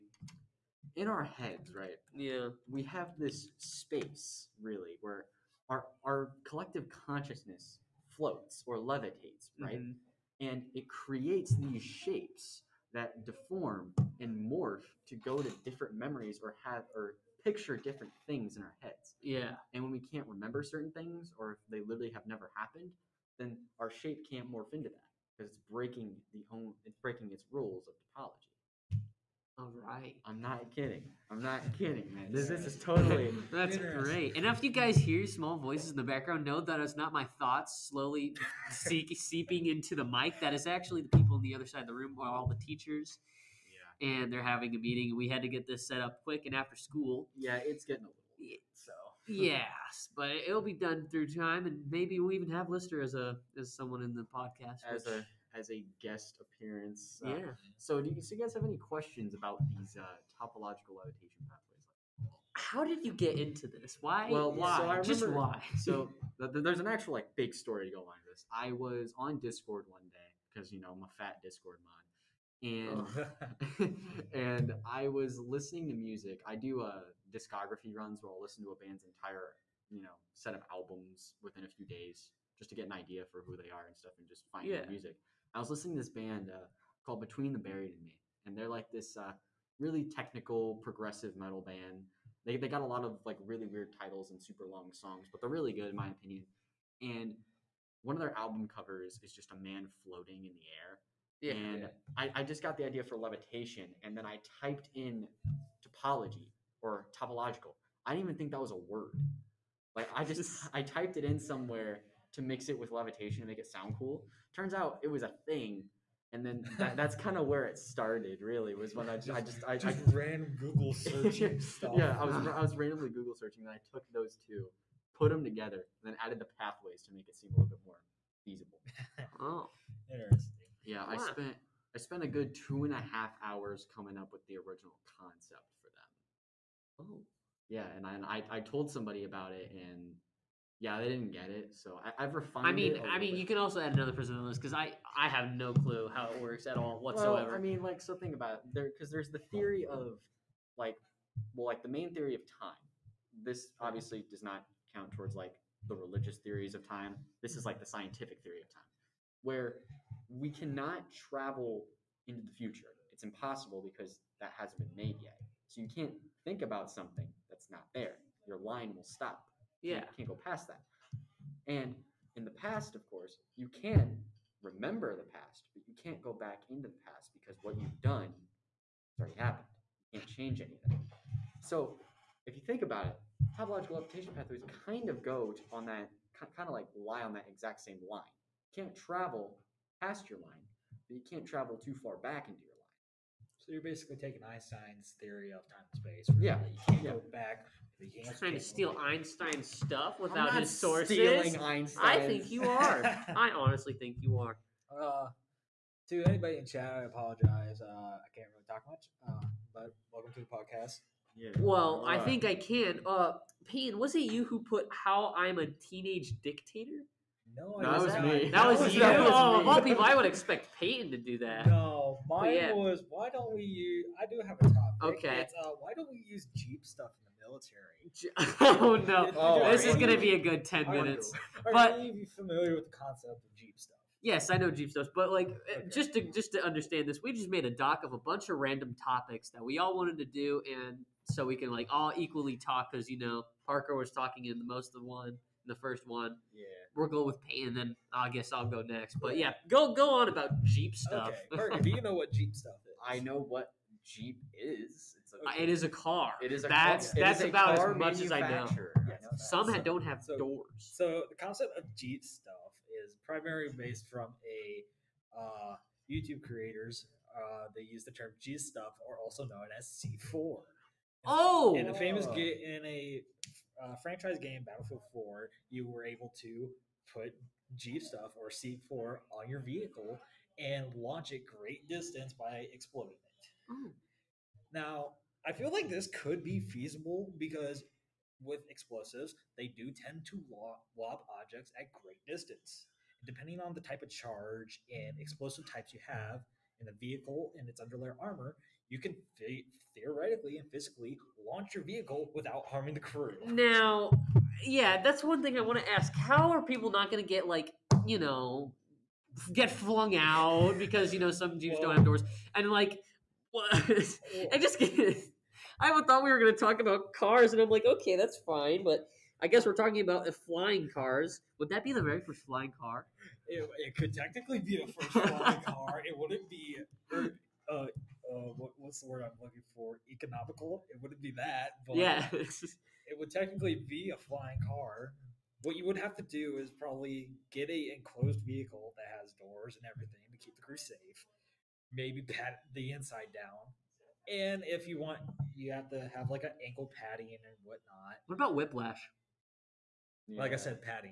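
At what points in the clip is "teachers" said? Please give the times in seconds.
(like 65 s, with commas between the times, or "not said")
42 s.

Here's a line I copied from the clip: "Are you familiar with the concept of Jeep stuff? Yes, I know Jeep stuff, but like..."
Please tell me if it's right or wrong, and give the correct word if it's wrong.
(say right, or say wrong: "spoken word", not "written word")
right.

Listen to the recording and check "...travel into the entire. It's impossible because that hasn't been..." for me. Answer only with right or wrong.
wrong.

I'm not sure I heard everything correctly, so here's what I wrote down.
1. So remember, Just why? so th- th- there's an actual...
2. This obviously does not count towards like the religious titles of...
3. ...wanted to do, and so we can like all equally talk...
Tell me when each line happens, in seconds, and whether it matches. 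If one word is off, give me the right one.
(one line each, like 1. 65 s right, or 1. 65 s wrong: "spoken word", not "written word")
1. 64 s right
2. 153 s wrong: "theories", not "titles"
3. 239 s right.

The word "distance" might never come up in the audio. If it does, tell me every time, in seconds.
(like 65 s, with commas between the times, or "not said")
281 s, 292 s.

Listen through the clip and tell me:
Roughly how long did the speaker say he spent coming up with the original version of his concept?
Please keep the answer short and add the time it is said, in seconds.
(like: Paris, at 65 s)
two and a half hours, at 132 s.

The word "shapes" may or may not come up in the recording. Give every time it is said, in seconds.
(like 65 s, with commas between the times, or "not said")
11 s, 23 s.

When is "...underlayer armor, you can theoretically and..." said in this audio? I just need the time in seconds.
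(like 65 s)
297 s.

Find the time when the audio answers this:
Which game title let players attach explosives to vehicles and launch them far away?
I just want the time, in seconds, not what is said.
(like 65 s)
274 s.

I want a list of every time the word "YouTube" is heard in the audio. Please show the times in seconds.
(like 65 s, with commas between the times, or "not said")
266 s.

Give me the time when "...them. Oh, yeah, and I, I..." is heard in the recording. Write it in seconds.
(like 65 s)
137 s.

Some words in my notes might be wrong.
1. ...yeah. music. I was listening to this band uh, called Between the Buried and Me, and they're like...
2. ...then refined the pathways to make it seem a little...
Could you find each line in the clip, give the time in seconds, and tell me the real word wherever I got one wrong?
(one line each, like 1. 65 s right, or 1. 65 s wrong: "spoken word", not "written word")
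1. 84 s right
2. 126 s wrong: "added", not "refined".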